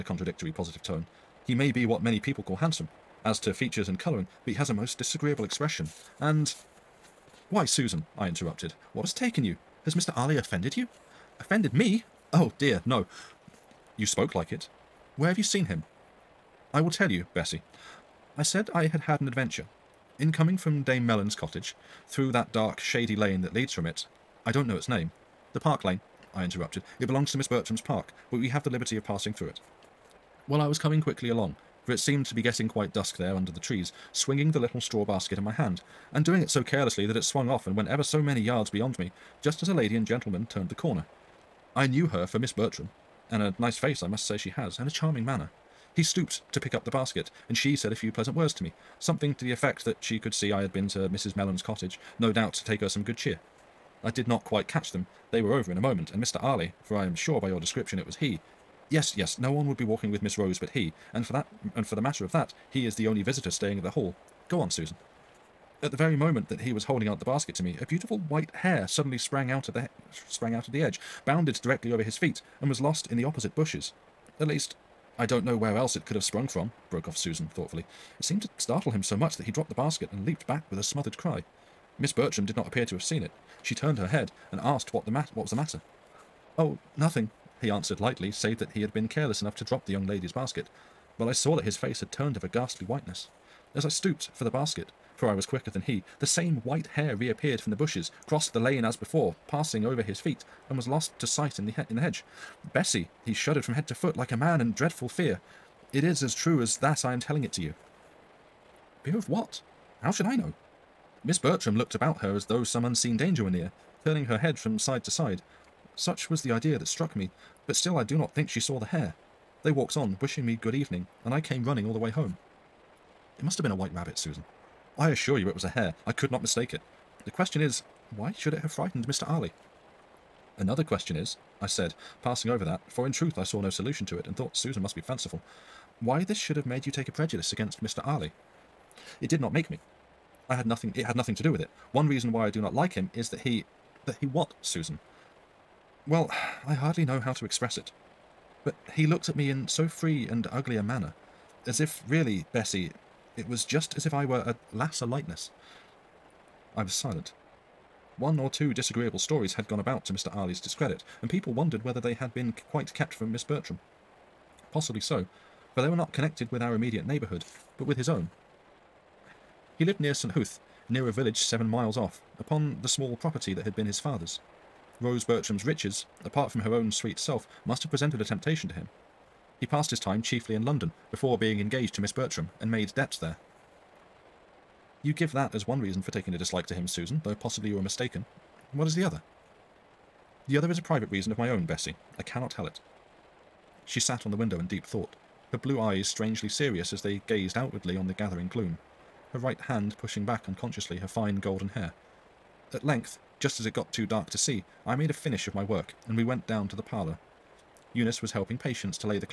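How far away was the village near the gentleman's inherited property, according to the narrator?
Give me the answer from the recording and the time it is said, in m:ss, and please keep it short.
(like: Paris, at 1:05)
7 miles, at 2:51.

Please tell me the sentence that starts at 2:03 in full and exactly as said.
It must have been a white rabbit, Susan.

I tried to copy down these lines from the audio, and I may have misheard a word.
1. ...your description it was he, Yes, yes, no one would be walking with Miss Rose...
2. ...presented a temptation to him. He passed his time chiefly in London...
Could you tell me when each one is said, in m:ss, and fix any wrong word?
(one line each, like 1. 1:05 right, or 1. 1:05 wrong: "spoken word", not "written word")
1. 0:57 right
2. 2:57 right.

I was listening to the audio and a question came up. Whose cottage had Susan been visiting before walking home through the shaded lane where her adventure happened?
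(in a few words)
Dame Mellon.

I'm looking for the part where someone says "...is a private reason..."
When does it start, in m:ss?
3:10.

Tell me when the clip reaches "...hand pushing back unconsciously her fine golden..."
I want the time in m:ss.
3:19.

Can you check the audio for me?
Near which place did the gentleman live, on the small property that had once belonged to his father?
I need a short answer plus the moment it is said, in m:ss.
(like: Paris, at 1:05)
St. Huth, at 2:50.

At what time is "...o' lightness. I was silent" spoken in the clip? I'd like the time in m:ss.
2:34.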